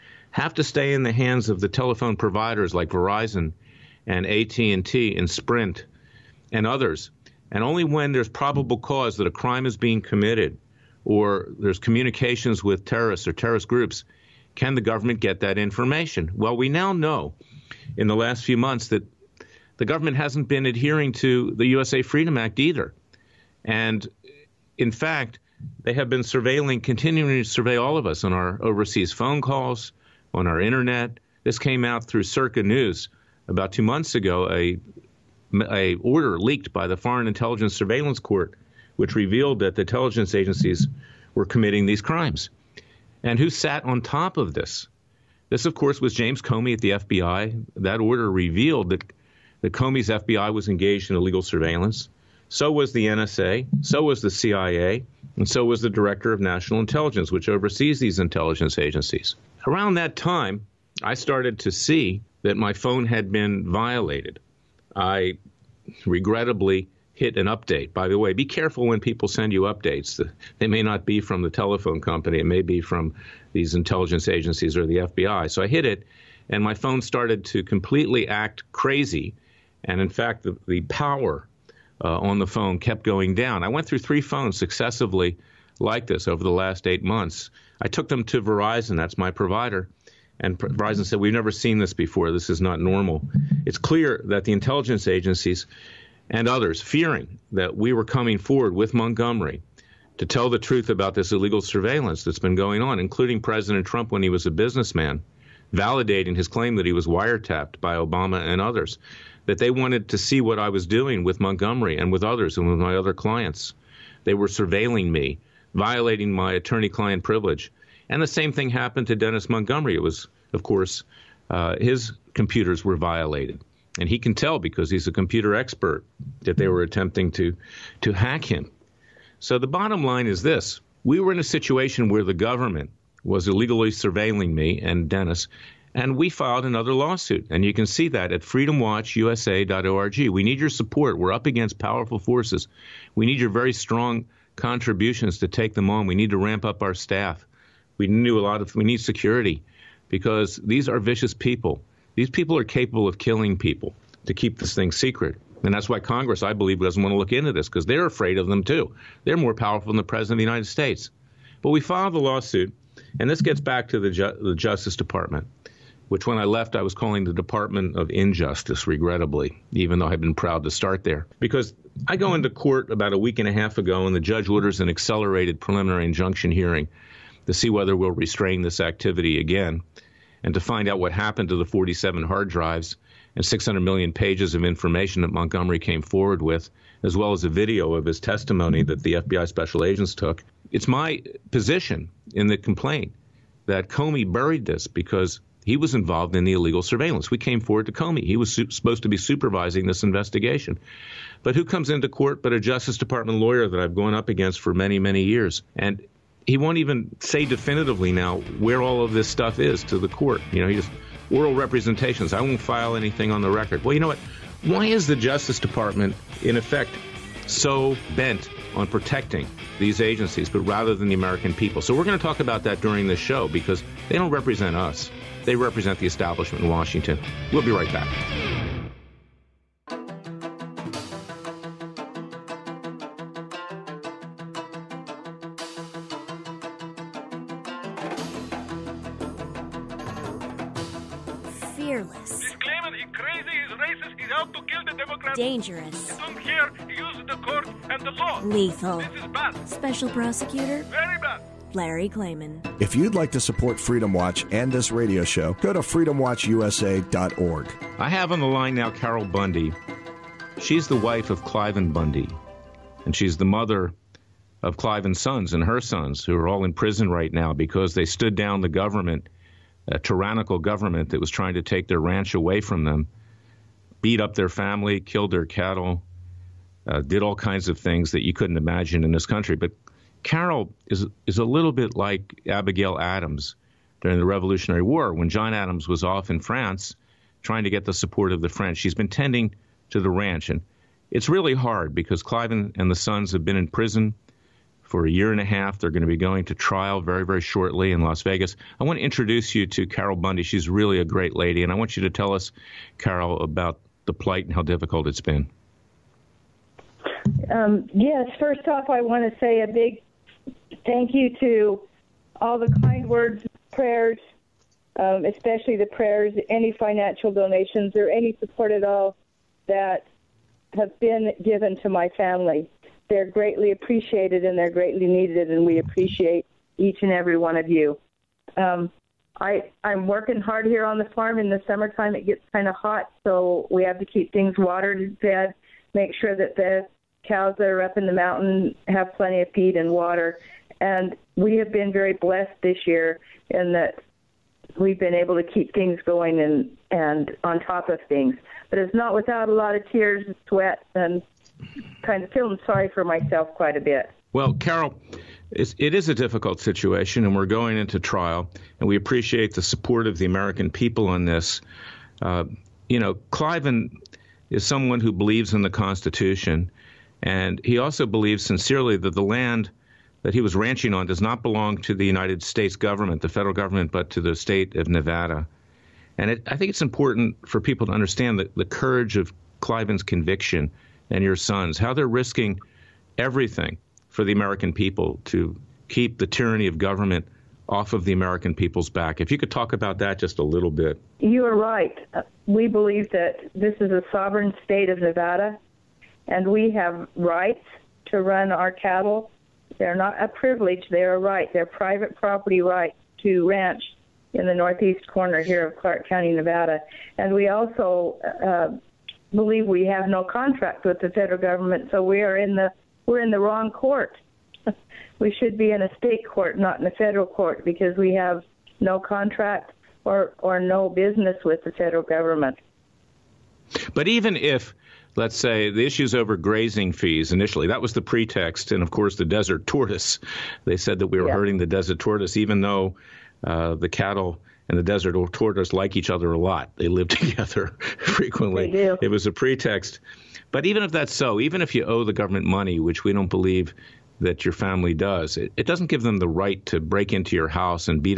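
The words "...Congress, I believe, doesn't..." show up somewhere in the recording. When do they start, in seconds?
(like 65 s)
155 s.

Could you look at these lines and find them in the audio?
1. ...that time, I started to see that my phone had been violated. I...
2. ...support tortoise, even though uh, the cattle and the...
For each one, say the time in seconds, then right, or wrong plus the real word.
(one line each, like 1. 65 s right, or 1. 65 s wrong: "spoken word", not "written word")
1. 59 s right
2. 431 s wrong: "desert", not "support".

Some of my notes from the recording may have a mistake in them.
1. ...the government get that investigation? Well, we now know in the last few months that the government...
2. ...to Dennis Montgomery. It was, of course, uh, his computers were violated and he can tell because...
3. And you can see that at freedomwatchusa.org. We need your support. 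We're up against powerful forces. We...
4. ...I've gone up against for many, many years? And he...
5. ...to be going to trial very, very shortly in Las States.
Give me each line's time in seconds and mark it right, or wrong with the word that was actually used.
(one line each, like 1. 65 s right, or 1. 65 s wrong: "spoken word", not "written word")
1. 14 s wrong: "information", not "investigation"
2. 119 s right
3. 137 s right
4. 203 s right
5. 296 s wrong: "Vegas", not "States".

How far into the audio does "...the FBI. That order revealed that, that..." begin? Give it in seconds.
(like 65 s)
46 s.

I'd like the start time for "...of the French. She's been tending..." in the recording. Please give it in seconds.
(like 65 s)
288 s.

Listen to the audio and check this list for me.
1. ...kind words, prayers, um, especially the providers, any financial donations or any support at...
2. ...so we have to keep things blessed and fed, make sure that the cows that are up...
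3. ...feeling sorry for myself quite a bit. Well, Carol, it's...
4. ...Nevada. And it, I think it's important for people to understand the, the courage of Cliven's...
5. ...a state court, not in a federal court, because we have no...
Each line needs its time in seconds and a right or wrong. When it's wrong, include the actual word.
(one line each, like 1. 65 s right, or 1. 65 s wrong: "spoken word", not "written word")
1. 312 s wrong: "prayers", not "providers"
2. 333 s wrong: "watered", not "blessed"
3. 352 s right
4. 374 s right
5. 415 s right.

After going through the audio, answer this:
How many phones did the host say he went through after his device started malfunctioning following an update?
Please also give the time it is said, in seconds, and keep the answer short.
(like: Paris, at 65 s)
3, at 83 s.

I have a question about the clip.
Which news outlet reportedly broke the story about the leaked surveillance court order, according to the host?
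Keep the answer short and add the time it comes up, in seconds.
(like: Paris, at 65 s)
Circa News, at 32 s.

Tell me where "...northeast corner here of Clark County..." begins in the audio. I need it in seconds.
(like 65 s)
404 s.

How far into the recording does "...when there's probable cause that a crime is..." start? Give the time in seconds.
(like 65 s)
7 s.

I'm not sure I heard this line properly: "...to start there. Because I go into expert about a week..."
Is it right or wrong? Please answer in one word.
wrong.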